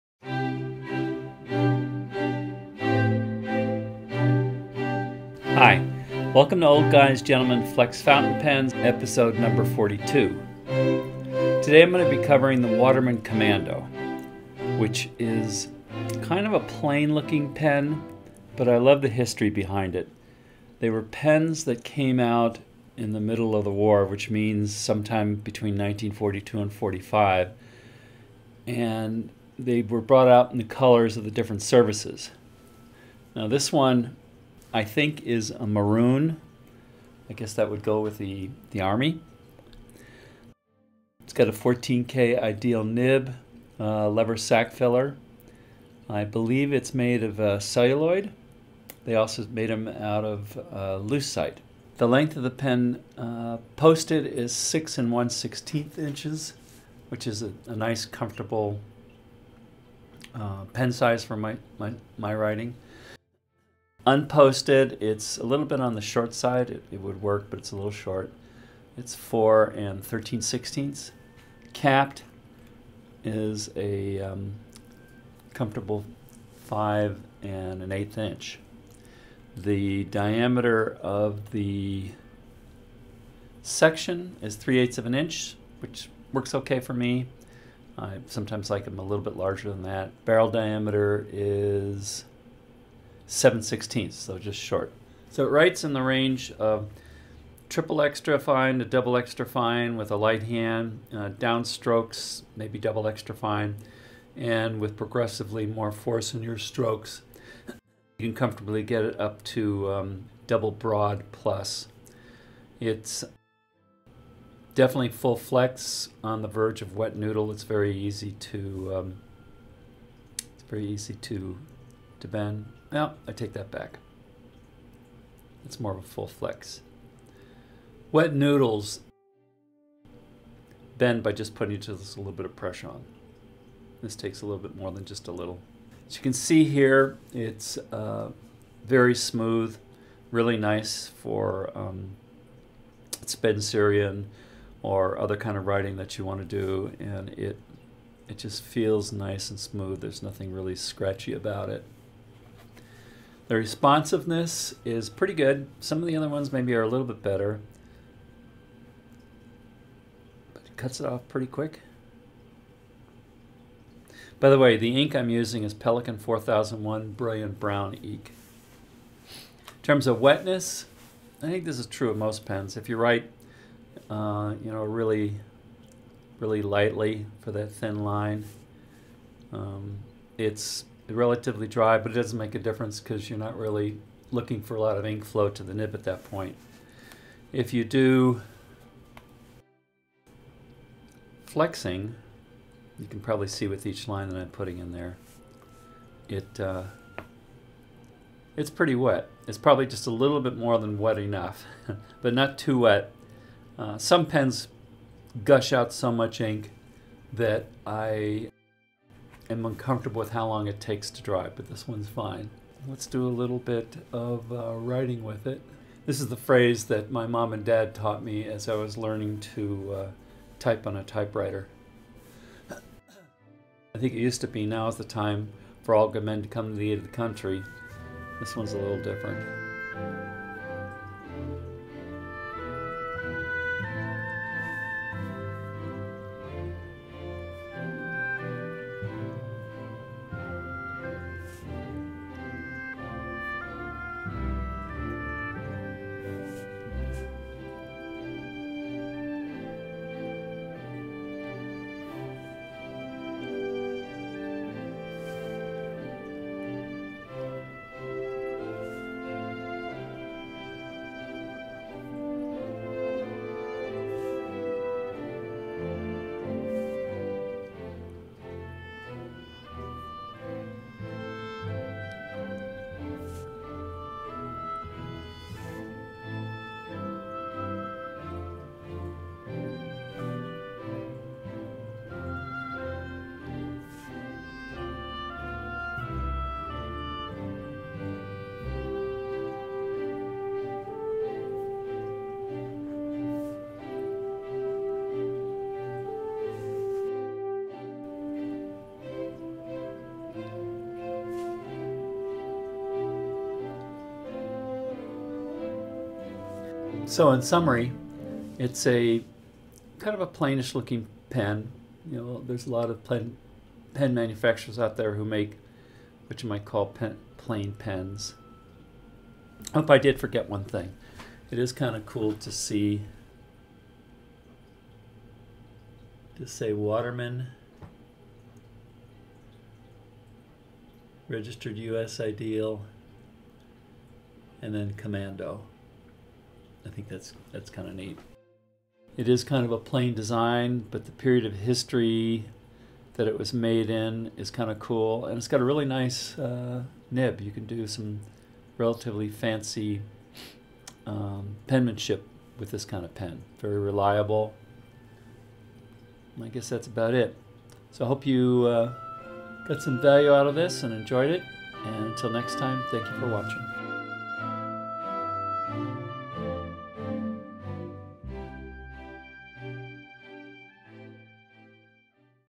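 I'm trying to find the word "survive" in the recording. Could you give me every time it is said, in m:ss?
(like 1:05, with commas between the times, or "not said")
not said.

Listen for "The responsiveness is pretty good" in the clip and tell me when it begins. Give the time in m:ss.
2:33.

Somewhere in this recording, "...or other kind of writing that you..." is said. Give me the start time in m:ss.
2:24.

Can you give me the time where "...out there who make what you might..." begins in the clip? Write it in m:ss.
5:14.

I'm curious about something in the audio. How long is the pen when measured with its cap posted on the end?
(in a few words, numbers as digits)
6 1/16 inches.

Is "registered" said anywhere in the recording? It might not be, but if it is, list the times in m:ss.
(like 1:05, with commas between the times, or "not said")
5:31.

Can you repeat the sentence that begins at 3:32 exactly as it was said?
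Let's do a little bit of uh, writing with it.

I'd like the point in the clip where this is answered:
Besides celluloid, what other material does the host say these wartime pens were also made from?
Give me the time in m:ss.
0:51.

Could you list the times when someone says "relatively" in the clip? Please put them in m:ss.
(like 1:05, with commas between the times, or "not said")
3:01, 5:48.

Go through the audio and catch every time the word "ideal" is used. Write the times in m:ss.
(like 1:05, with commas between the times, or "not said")
0:42, 5:32.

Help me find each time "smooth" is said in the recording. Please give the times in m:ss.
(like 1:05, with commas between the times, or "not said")
2:19, 2:29.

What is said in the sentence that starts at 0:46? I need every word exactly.
I believe it's made of uh, celluloid.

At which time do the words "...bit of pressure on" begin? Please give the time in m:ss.
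2:12.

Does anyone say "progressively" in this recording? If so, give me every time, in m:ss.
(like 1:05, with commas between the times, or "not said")
1:44.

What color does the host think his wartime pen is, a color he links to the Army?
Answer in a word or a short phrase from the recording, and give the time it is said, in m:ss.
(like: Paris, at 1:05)
Maroon, at 0:35.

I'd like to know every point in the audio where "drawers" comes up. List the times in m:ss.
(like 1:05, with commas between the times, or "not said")
not said.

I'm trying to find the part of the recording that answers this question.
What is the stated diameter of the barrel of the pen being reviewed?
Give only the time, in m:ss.
1:33.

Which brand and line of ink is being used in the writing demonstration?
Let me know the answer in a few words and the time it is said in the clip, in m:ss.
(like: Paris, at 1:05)
Pelikan 4001, at 2:45.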